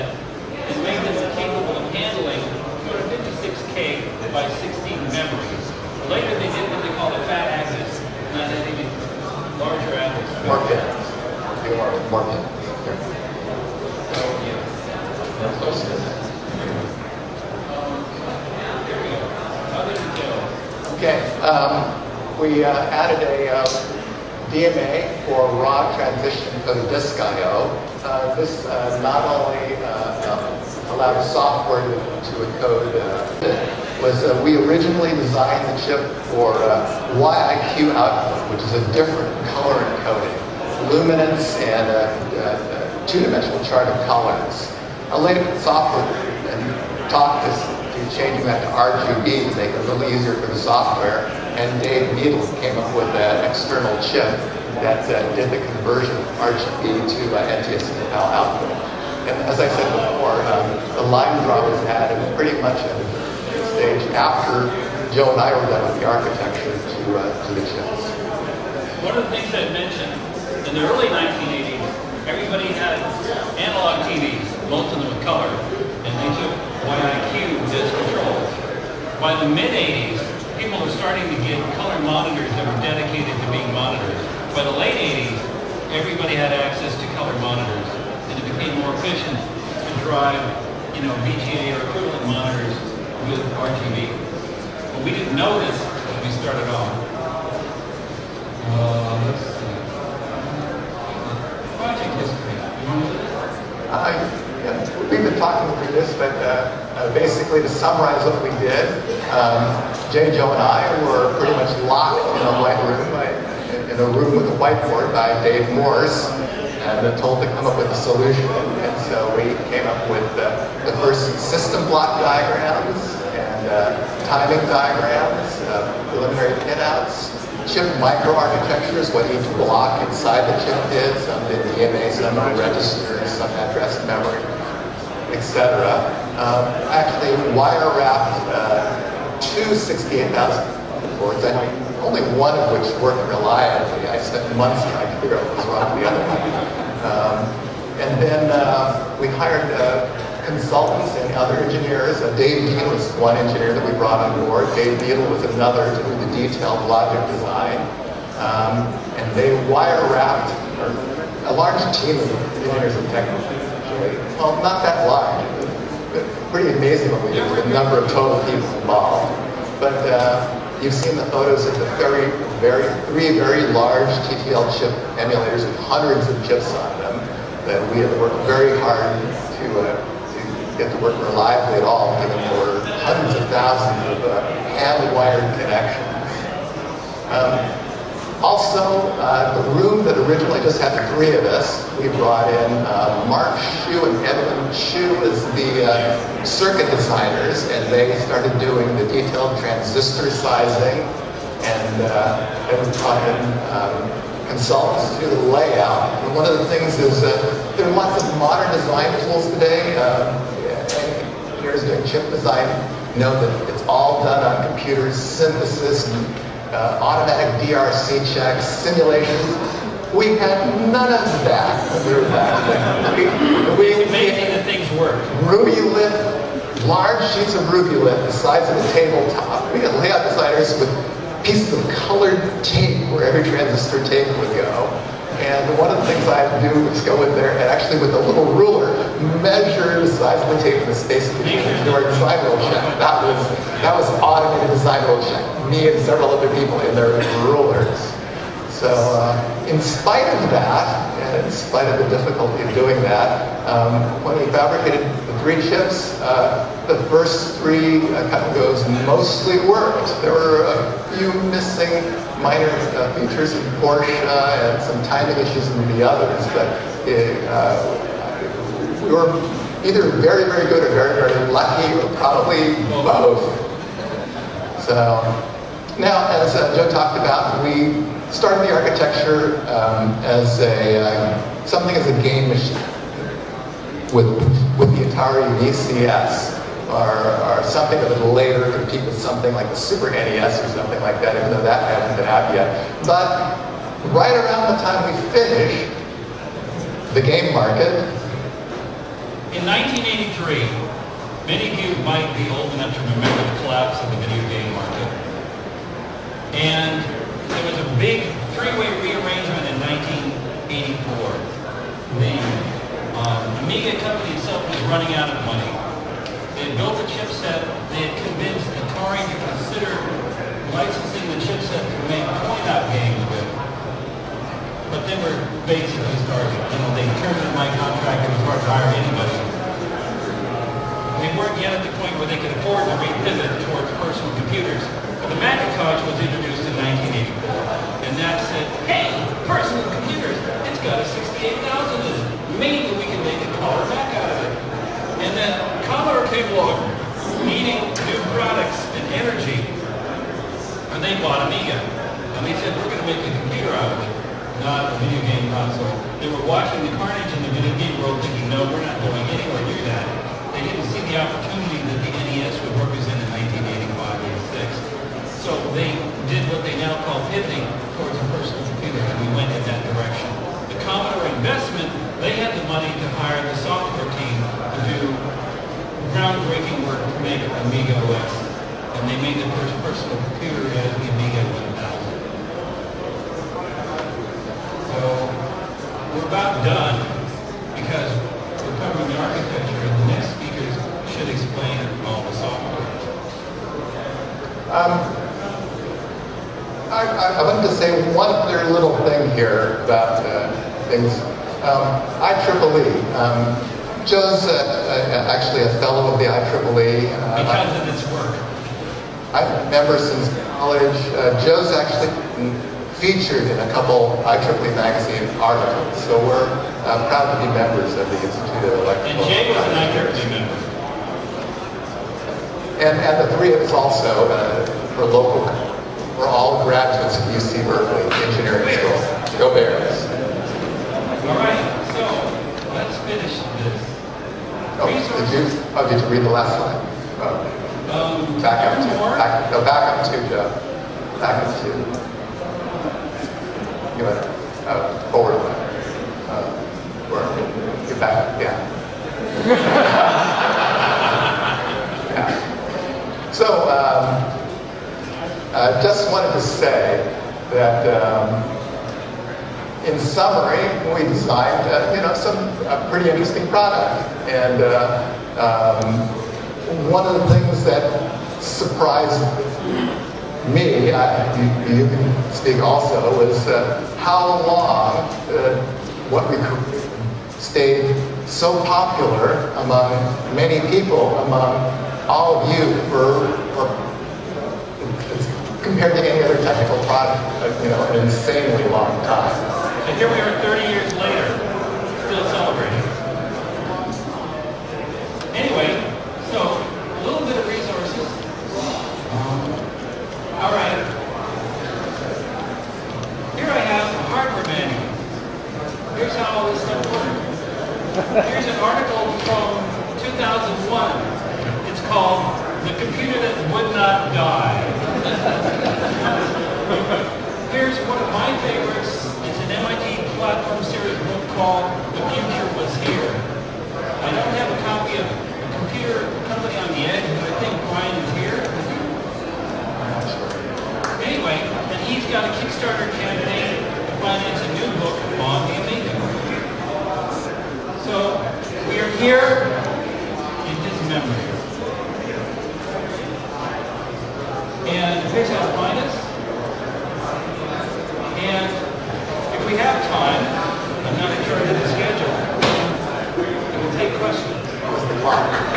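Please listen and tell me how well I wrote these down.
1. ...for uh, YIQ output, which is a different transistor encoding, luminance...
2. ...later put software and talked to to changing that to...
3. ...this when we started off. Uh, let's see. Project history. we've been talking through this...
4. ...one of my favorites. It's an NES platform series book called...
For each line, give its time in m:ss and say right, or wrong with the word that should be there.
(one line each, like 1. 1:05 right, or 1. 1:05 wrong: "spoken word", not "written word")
1. 0:36 wrong: "color", not "transistor"
2. 0:45 right
3. 1:35 right
4. 8:37 wrong: "MIT", not "NES".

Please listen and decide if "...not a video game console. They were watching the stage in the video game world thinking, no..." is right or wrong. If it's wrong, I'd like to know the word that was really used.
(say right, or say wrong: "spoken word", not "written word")
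wrong: "carnage", not "stage".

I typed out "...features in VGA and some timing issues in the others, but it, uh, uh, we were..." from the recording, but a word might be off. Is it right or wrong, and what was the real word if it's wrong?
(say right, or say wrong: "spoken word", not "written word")
wrong: "Portia", not "VGA".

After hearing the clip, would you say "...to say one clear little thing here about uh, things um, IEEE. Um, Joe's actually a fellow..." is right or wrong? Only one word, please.
right.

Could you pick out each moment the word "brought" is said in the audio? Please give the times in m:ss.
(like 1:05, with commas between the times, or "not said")
2:33, 3:12, 3:23.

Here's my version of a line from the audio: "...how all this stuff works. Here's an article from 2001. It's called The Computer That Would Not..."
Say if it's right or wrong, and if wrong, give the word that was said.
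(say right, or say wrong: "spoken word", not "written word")
right.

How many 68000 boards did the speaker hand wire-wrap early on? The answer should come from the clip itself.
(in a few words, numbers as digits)
2.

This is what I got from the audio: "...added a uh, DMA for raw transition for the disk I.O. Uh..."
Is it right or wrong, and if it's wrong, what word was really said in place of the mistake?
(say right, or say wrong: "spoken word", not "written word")
right.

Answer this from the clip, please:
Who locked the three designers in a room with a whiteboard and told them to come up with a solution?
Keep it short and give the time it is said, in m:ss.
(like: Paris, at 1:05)
Dave Morse, at 1:55.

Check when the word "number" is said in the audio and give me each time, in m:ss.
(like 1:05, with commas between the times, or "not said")
2:47.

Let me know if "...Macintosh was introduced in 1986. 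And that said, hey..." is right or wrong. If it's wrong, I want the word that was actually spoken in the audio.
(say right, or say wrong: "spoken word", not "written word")
wrong: "1984", not "1986".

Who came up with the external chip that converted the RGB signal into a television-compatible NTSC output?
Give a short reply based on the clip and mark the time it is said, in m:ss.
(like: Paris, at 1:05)
Dave Needles, at 0:51.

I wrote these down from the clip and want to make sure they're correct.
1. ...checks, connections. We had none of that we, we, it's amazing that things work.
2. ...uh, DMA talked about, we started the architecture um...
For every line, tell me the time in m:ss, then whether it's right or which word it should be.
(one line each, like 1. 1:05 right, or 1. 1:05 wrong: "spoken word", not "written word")
1. 3:38 wrong: "simulations", not "connections"
2. 4:36 wrong: "Joe", not "DMA".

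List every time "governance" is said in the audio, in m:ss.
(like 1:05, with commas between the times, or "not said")
not said.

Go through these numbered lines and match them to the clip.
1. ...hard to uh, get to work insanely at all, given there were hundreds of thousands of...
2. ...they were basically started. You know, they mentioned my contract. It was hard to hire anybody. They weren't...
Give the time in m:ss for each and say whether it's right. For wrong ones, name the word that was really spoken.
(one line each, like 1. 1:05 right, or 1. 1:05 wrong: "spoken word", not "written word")
1. 2:58 wrong: "reliably", not "insanely"
2. 5:25 wrong: "terminated", not "mentioned".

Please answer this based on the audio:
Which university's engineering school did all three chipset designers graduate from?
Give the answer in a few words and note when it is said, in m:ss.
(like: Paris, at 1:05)
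UC Berkeley, at 7:07.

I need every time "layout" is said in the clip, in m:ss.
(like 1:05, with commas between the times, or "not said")
3:25, 3:49.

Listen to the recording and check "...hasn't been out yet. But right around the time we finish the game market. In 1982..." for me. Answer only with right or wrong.
wrong.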